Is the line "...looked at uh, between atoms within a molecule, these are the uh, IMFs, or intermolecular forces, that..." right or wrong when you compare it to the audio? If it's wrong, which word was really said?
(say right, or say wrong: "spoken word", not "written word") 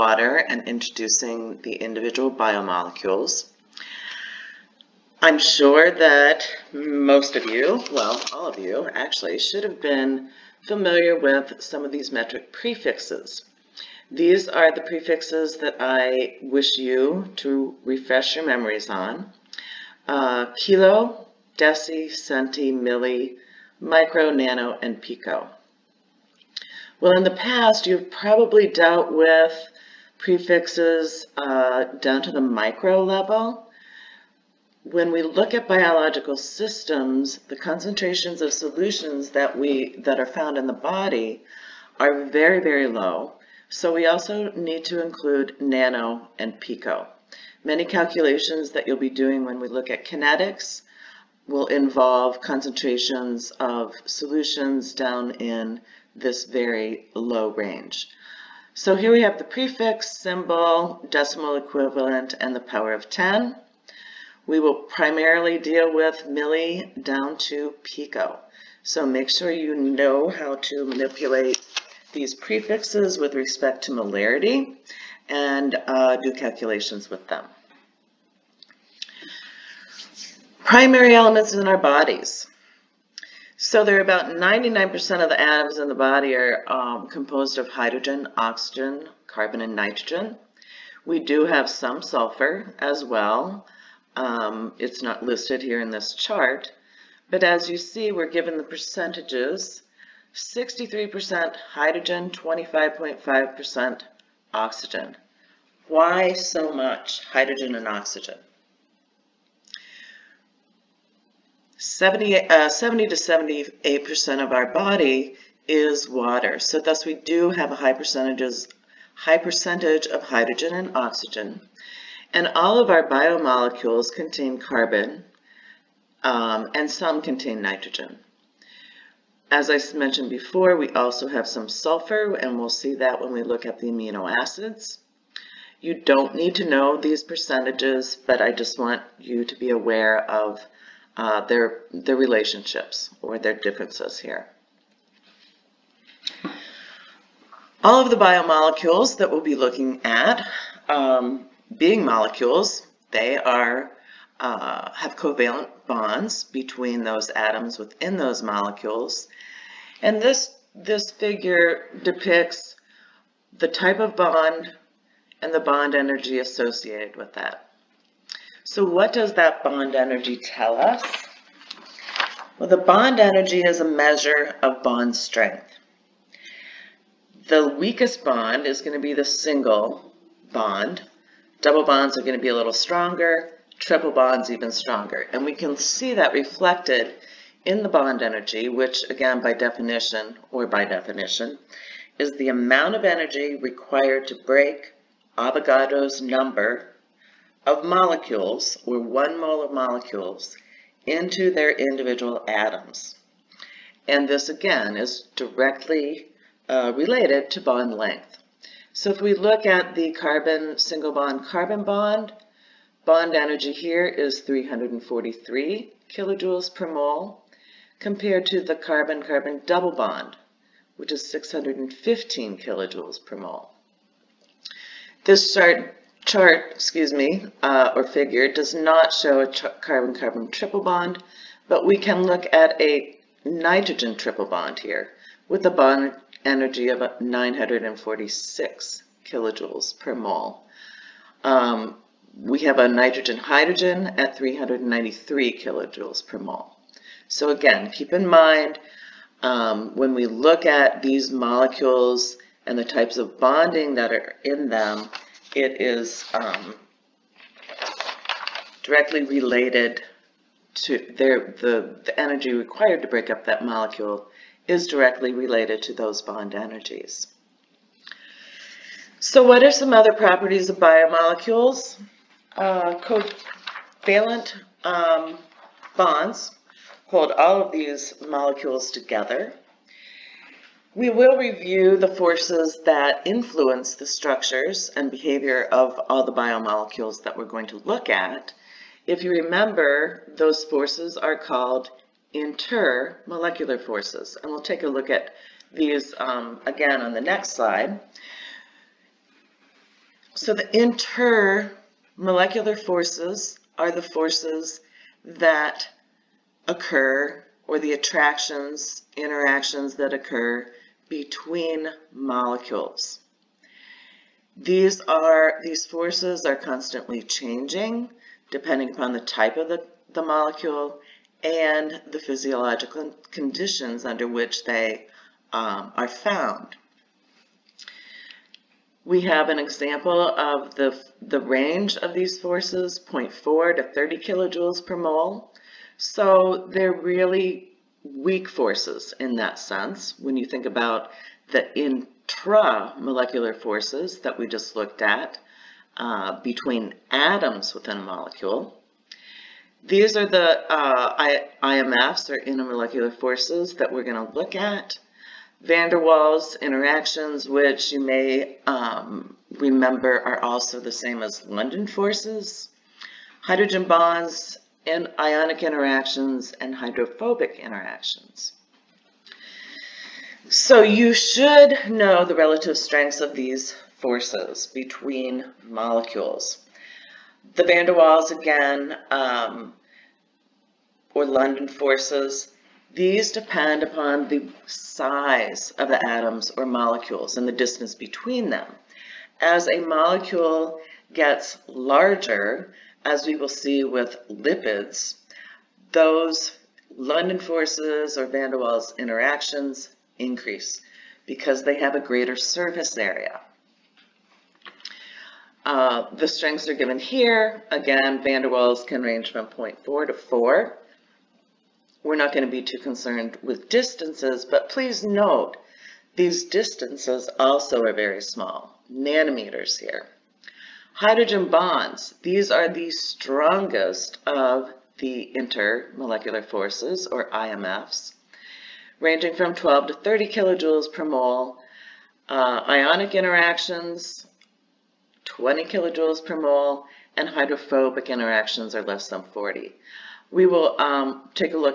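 right.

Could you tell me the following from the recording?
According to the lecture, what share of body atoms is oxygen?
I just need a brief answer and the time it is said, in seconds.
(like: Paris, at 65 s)
25.5%, at 102 s.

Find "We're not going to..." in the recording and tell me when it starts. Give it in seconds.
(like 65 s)
412 s.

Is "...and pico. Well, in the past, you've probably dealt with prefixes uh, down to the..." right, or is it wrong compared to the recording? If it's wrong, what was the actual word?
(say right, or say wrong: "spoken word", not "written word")
right.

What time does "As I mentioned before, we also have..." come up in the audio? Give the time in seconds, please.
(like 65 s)
129 s.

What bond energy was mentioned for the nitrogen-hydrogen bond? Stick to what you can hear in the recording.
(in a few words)
393 kilojoules per mole.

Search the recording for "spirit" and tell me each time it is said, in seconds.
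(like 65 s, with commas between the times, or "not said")
not said.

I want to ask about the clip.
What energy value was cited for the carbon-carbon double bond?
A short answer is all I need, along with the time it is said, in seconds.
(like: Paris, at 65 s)
615 kilojoules per mole, at 221 s.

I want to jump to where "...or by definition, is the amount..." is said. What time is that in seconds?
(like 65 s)
190 s.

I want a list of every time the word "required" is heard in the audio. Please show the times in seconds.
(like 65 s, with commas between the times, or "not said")
193 s, 262 s.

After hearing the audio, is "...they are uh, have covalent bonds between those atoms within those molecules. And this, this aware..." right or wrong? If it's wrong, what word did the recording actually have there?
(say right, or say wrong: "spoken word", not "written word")
wrong: "figure", not "aware".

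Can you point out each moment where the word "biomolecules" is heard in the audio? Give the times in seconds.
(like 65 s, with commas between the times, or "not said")
2 s, 123 s, 148 s, 270 s, 286 s.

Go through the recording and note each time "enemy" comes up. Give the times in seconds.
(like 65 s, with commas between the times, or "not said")
not said.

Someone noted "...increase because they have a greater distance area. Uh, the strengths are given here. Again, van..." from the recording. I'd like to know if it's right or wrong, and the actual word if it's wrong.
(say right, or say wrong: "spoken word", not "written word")
wrong: "surface", not "distance".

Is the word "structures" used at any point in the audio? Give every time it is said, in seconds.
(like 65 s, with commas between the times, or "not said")
284 s.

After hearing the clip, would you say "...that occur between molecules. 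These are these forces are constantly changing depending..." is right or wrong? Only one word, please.
right.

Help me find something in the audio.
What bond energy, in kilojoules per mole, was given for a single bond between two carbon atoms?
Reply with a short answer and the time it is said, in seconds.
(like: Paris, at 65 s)
343, at 214 s.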